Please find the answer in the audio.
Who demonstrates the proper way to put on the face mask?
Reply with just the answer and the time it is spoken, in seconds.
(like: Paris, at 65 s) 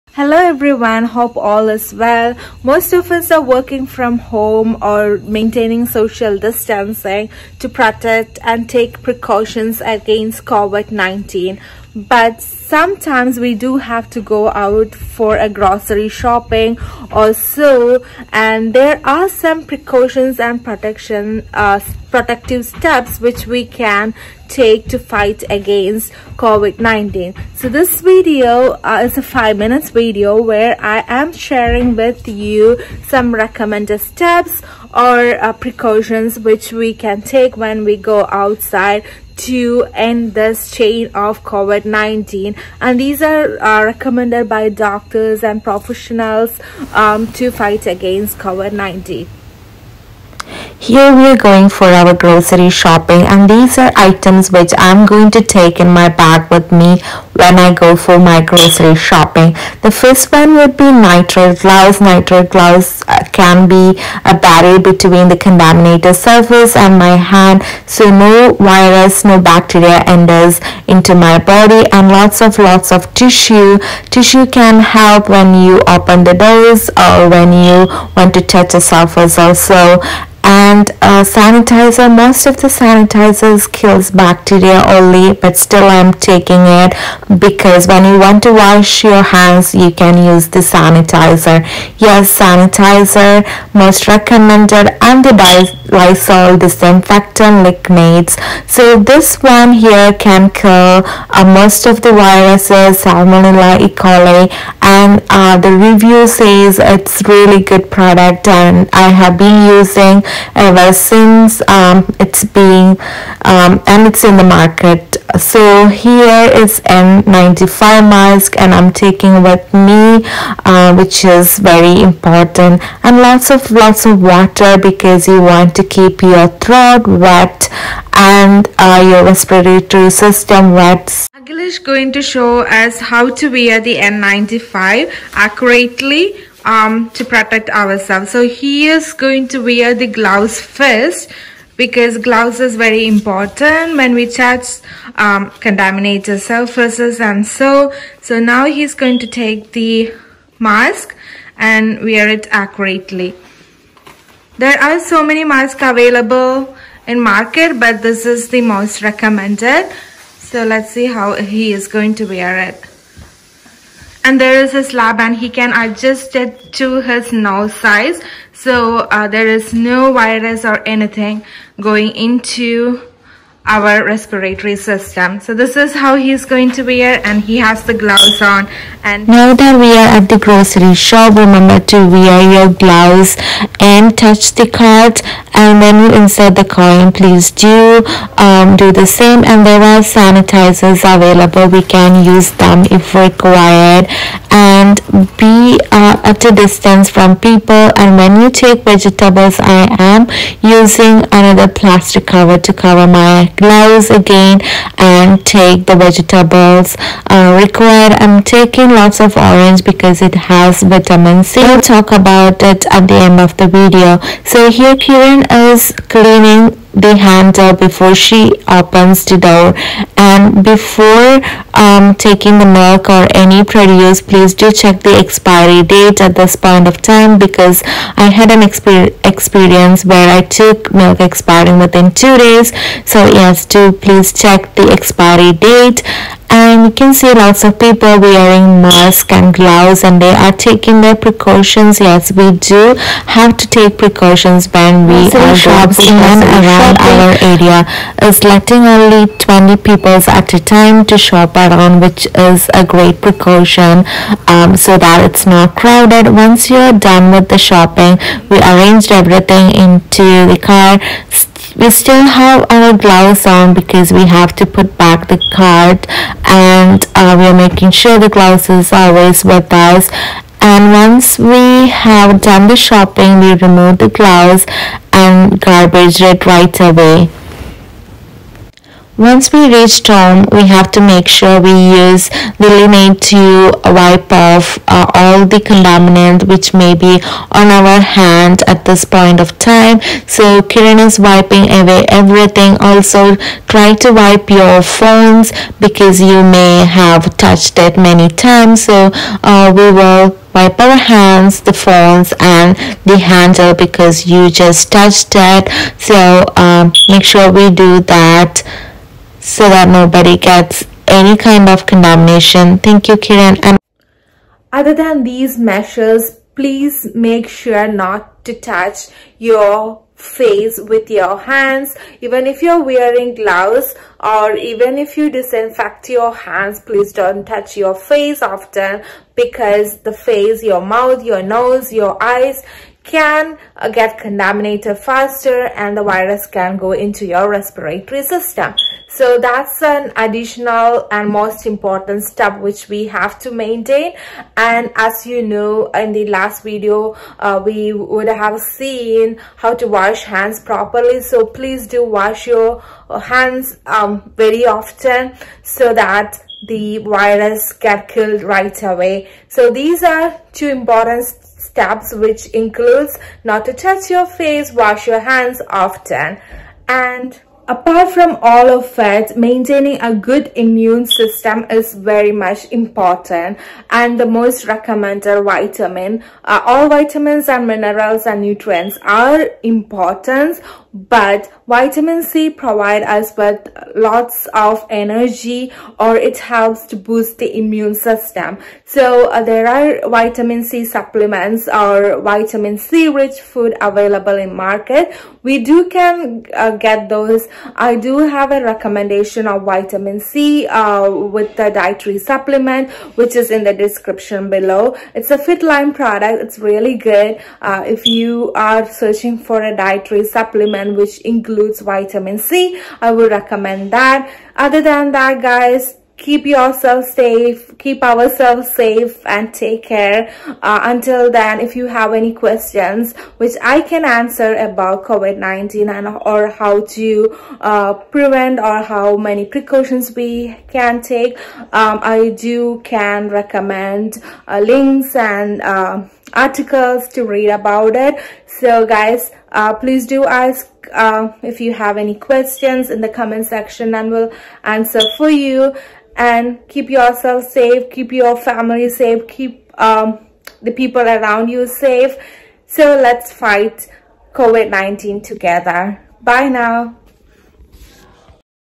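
Agil, at 131 s.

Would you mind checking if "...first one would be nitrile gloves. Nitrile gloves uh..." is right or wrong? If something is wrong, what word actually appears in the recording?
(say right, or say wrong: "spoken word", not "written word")
right.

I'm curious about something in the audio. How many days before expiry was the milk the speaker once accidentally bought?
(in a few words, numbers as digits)
2.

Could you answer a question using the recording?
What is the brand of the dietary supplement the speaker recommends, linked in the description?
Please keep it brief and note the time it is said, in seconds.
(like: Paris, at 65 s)
FitLine, at 405 s.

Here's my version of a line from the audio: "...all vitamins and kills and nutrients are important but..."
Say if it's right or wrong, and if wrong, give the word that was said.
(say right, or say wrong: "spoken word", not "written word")
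wrong: "minerals", not "kills".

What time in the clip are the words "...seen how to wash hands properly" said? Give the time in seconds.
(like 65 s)
348 s.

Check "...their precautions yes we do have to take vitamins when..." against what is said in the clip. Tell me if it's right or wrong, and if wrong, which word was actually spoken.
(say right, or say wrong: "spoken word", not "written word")
wrong: "precautions", not "vitamins".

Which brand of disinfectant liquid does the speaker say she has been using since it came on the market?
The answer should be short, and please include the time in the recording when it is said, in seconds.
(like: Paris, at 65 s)
Lysol, at 95 s.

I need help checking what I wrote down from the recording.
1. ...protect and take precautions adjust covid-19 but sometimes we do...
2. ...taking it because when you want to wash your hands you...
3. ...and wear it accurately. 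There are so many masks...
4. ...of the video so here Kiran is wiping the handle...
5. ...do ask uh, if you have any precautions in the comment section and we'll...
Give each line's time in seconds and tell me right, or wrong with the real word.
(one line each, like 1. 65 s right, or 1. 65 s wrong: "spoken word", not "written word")
1. 7 s wrong: "against", not "adjust"
2. 86 s right
3. 151 s right
4. 213 s wrong: "cleaning", not "wiping"
5. 440 s wrong: "questions", not "precautions".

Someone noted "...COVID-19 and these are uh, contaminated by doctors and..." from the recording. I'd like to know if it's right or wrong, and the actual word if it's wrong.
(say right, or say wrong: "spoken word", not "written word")
wrong: "recommended", not "contaminated".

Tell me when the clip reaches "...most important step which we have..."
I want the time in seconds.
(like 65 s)
341 s.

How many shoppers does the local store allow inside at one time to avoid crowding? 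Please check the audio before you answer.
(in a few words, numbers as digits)
20.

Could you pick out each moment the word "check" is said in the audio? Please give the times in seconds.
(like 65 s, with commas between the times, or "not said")
224 s, 234 s.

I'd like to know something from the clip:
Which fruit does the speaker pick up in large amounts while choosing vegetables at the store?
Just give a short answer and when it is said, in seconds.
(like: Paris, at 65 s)
Orange, at 209 s.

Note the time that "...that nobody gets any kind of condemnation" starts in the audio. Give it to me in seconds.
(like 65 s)
309 s.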